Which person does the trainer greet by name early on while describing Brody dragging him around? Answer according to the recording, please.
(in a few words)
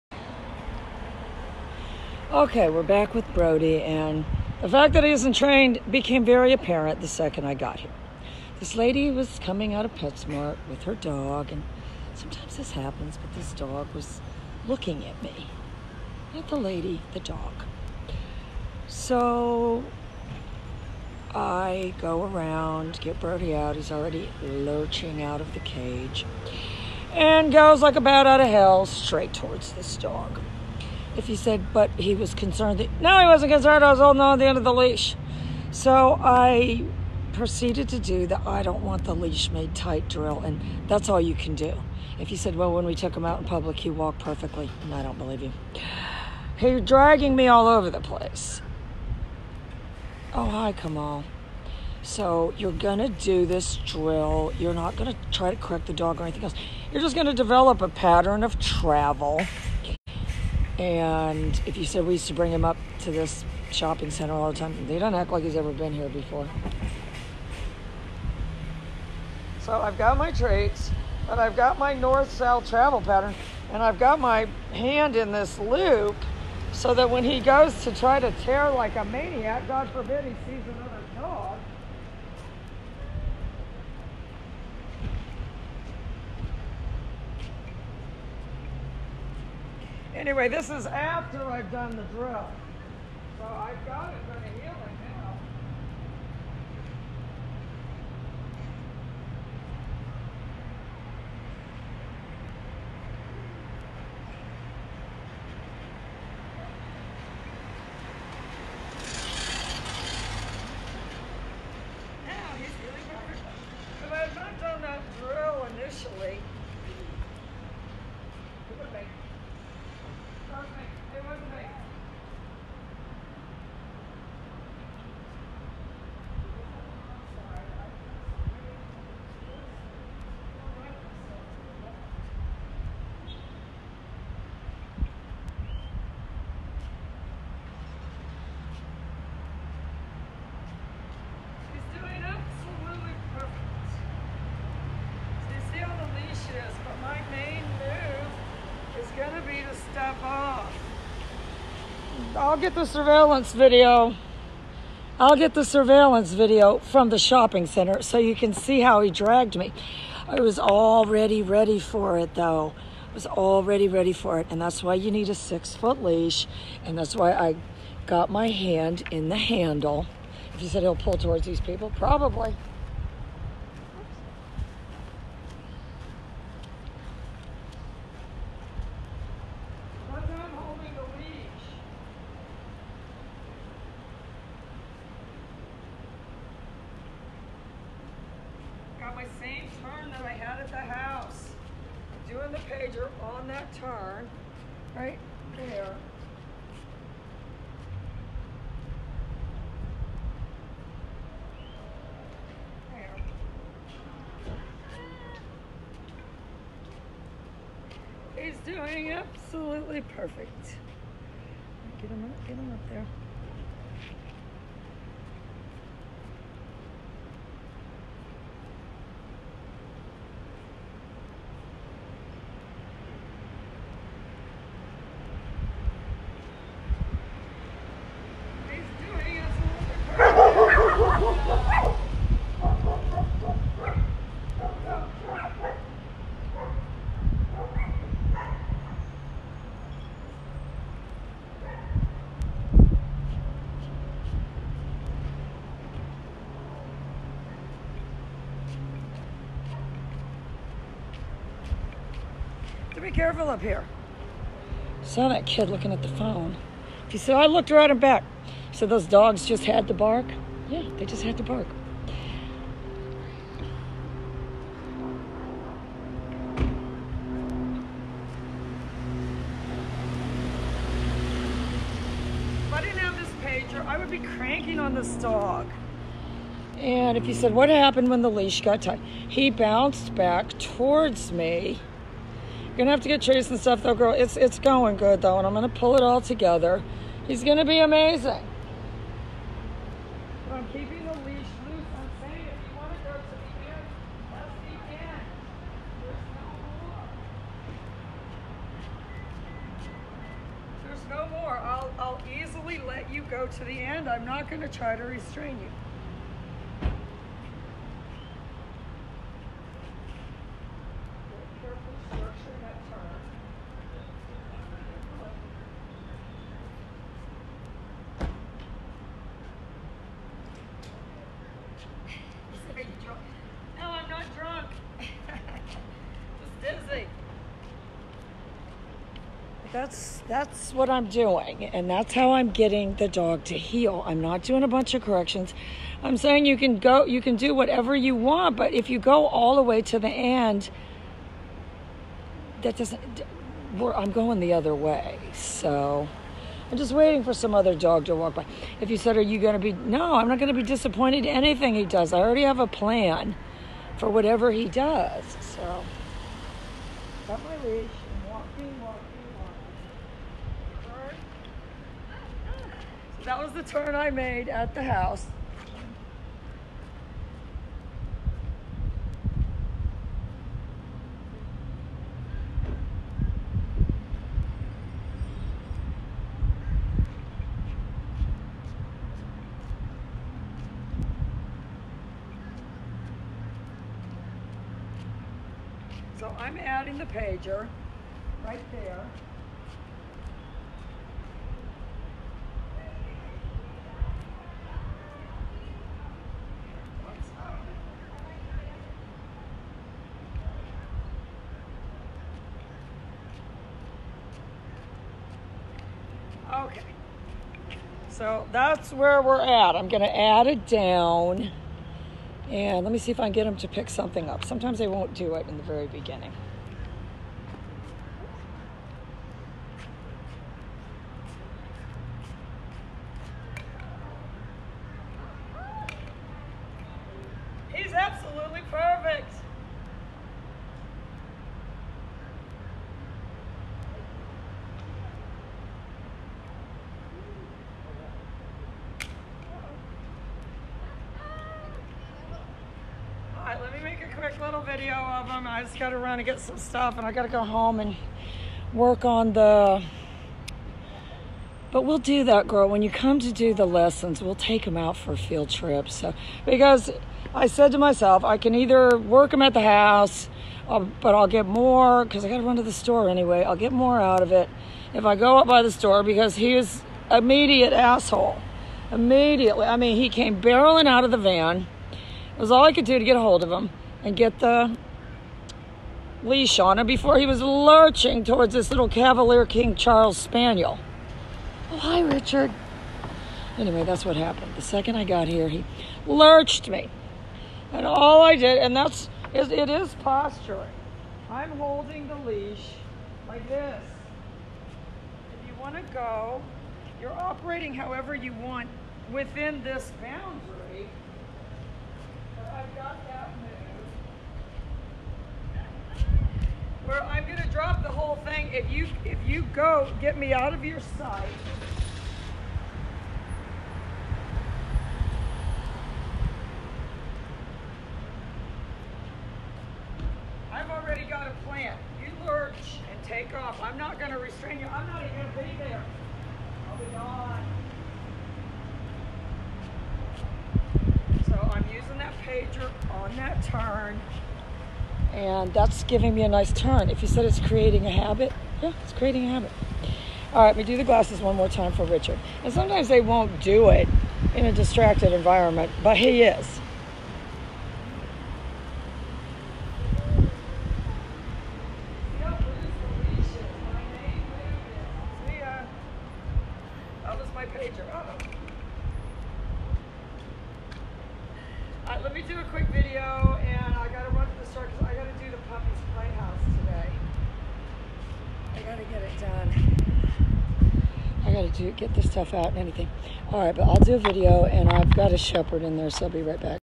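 Kamal.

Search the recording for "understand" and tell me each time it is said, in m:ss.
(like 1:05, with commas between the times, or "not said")
not said.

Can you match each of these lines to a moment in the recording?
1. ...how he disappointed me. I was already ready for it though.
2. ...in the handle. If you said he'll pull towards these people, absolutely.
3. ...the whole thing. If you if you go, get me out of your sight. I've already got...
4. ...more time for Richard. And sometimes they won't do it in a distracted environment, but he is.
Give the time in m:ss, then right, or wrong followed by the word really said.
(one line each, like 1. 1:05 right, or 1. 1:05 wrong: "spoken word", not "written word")
1. 2:38 wrong: "dragged", not "disappointed"
2. 2:49 wrong: "probably", not "absolutely"
3. 8:27 right
4. 9:01 right.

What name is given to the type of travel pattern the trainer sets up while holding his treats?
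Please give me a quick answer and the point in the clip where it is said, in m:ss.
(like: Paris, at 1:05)
North-south, at 1:11.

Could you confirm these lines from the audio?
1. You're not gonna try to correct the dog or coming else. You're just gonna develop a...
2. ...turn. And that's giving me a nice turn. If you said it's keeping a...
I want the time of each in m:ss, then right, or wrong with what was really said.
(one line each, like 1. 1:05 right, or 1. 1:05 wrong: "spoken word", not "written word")
1. 0:54 wrong: "anything", not "coming"
2. 8:53 wrong: "creating", not "keeping".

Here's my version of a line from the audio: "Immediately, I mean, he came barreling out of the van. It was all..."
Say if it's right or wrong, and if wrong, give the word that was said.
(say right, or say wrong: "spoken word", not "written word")
right.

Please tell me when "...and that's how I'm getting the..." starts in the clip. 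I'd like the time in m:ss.
5:31.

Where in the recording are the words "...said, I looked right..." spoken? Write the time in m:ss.
4:17.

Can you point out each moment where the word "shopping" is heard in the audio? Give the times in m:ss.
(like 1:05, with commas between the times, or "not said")
1:03, 2:37.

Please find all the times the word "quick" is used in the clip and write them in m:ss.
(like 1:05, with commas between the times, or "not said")
7:24, 9:22.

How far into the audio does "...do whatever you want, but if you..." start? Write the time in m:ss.
5:37.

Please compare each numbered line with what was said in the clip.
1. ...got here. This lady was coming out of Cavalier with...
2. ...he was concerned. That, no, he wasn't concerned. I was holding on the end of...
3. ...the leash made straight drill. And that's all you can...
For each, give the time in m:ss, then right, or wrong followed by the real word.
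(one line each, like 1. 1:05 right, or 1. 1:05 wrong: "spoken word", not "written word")
1. 0:07 wrong: "PetSmart", not "Cavalier"
2. 0:31 right
3. 0:39 wrong: "tight", not "straight".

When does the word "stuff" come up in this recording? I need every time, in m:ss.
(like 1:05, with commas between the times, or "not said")
4:43, 7:26, 9:32.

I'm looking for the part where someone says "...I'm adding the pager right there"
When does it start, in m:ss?
6:26.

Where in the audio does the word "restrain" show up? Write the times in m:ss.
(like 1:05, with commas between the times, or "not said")
5:05, 8:44.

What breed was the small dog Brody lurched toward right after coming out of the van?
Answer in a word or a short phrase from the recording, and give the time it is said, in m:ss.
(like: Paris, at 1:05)
Cavalier King Charles Spaniel, at 7:58.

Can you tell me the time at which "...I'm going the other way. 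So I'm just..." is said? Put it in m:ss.
5:43.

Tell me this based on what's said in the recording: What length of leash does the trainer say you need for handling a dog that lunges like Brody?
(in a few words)
6 foot.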